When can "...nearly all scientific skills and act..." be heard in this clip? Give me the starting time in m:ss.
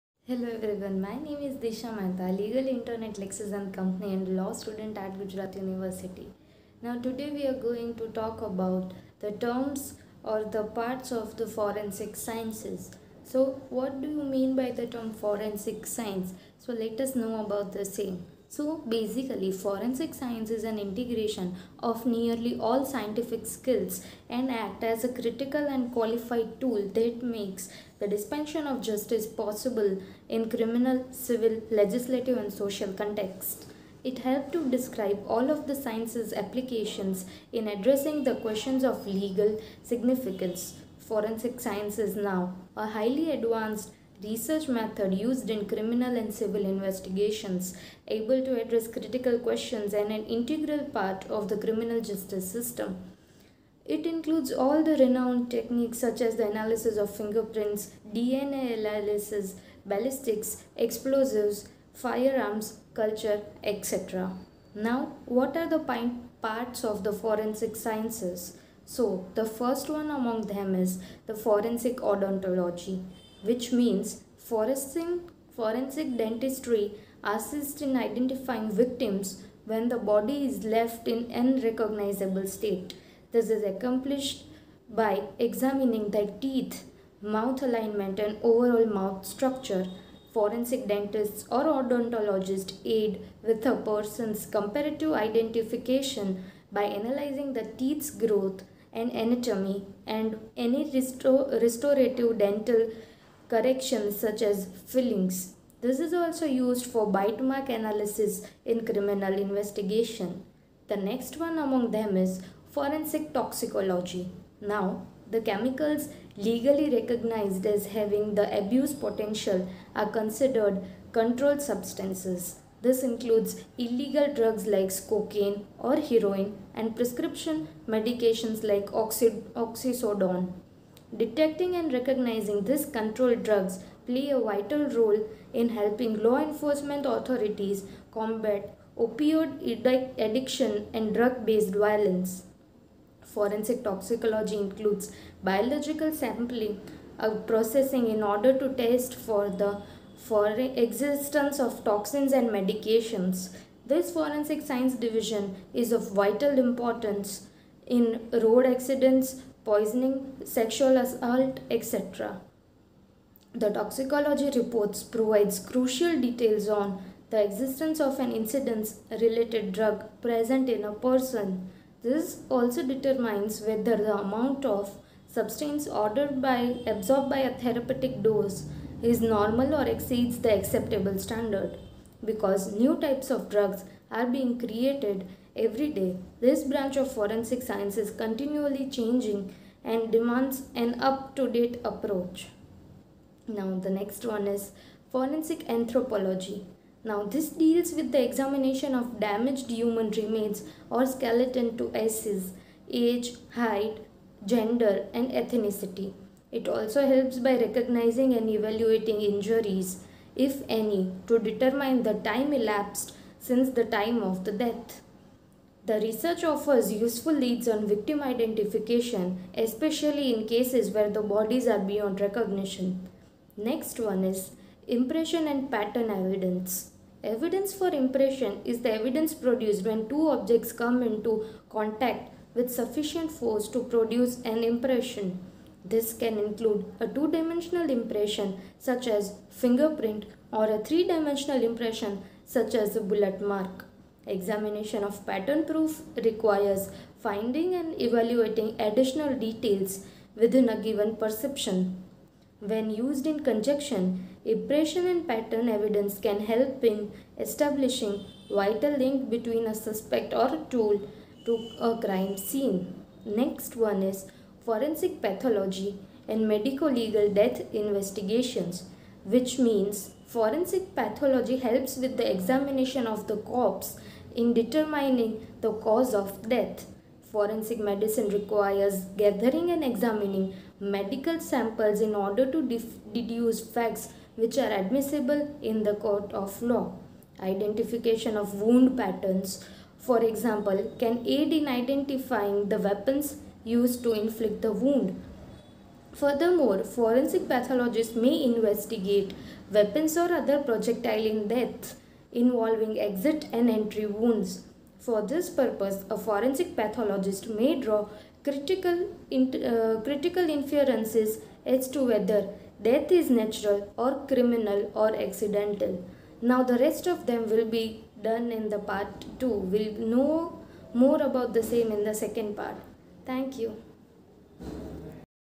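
0:22.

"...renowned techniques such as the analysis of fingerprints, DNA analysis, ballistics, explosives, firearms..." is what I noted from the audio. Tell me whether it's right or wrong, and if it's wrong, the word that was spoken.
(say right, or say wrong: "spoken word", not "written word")
right.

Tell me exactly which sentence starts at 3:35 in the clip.
The research offers useful leads on victim identification, especially in cases where the bodies are beyond recognition.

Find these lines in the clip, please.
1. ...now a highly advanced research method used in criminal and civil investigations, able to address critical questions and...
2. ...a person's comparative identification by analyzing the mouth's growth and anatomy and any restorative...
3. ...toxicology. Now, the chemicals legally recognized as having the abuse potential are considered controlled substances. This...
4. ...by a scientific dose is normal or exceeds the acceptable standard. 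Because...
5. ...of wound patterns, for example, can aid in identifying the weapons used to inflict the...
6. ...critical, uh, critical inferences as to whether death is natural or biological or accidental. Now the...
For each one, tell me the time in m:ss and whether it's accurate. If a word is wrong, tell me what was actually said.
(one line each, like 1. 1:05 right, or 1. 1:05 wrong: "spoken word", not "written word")
1. 0:42 right
2. 1:33 wrong: "teeth", not "mouth"
3. 1:53 right
4. 2:57 wrong: "therapeutic", not "scientific"
5. 4:48 right
6. 5:08 wrong: "criminal", not "biological".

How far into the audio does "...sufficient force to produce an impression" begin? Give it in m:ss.
3:52.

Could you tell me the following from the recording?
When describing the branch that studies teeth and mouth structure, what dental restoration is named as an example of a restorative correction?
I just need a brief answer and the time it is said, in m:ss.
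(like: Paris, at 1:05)
Fillings, at 1:44.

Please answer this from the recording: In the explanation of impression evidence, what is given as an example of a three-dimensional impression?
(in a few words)
A bullet mark.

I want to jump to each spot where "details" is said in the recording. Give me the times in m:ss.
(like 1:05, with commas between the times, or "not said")
2:46, 4:09.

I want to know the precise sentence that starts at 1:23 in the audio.
This is accomplished by examining the teeth, mouth alignment and overall mouth structure.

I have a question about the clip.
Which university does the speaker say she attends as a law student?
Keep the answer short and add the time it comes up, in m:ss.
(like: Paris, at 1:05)
Gujarat University, at 0:05.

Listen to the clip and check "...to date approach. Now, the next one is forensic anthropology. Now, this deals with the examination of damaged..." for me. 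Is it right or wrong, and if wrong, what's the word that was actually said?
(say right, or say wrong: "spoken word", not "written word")
right.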